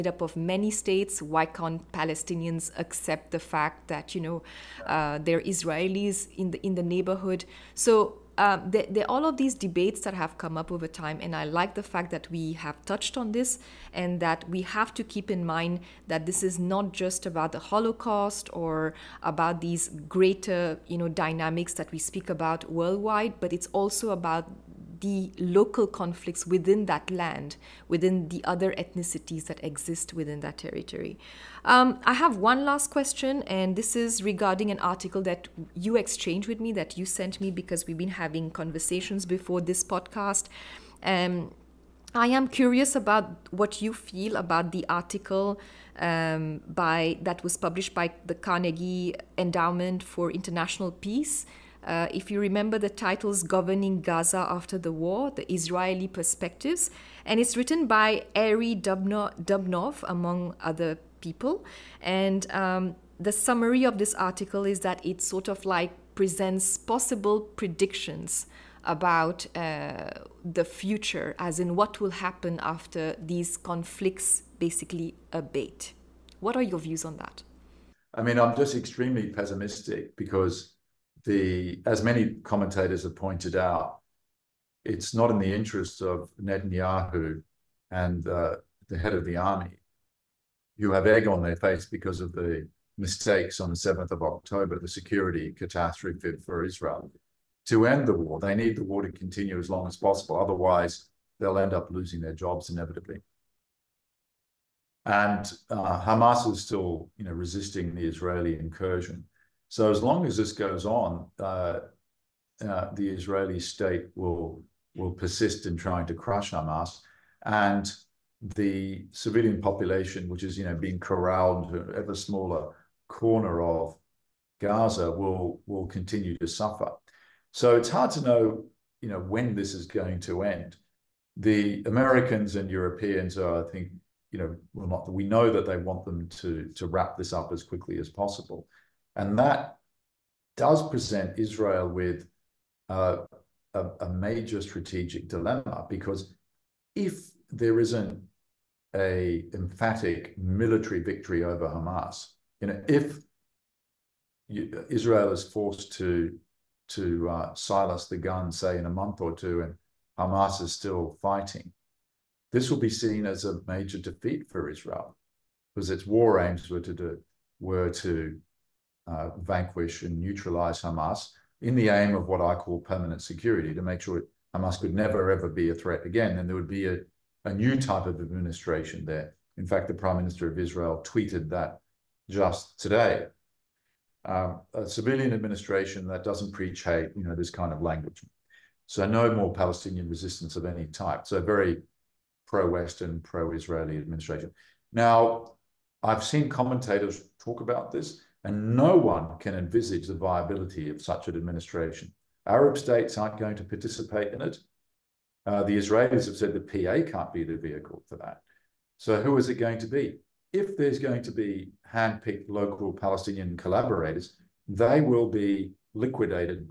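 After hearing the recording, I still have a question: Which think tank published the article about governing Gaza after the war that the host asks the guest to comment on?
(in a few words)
Carnegie Endowment for International Peace.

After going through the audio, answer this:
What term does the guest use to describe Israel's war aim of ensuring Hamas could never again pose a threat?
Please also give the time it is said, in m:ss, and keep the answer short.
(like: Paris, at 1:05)
permanent security, at 2:52.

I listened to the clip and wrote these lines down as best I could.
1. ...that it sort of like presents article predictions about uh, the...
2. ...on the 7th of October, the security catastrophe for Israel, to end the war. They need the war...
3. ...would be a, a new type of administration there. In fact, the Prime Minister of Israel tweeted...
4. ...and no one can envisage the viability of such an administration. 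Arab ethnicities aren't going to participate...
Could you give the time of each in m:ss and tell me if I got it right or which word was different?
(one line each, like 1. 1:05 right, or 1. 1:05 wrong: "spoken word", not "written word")
1. 1:04 wrong: "possible", not "article"
2. 1:33 right
3. 2:56 right
4. 3:18 wrong: "states", not "ethnicities".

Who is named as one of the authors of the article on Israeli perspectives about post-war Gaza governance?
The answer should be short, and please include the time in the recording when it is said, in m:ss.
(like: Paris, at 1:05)
Arie Dubnov, at 0:58.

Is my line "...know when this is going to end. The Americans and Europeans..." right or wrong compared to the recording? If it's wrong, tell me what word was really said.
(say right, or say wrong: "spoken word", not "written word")
right.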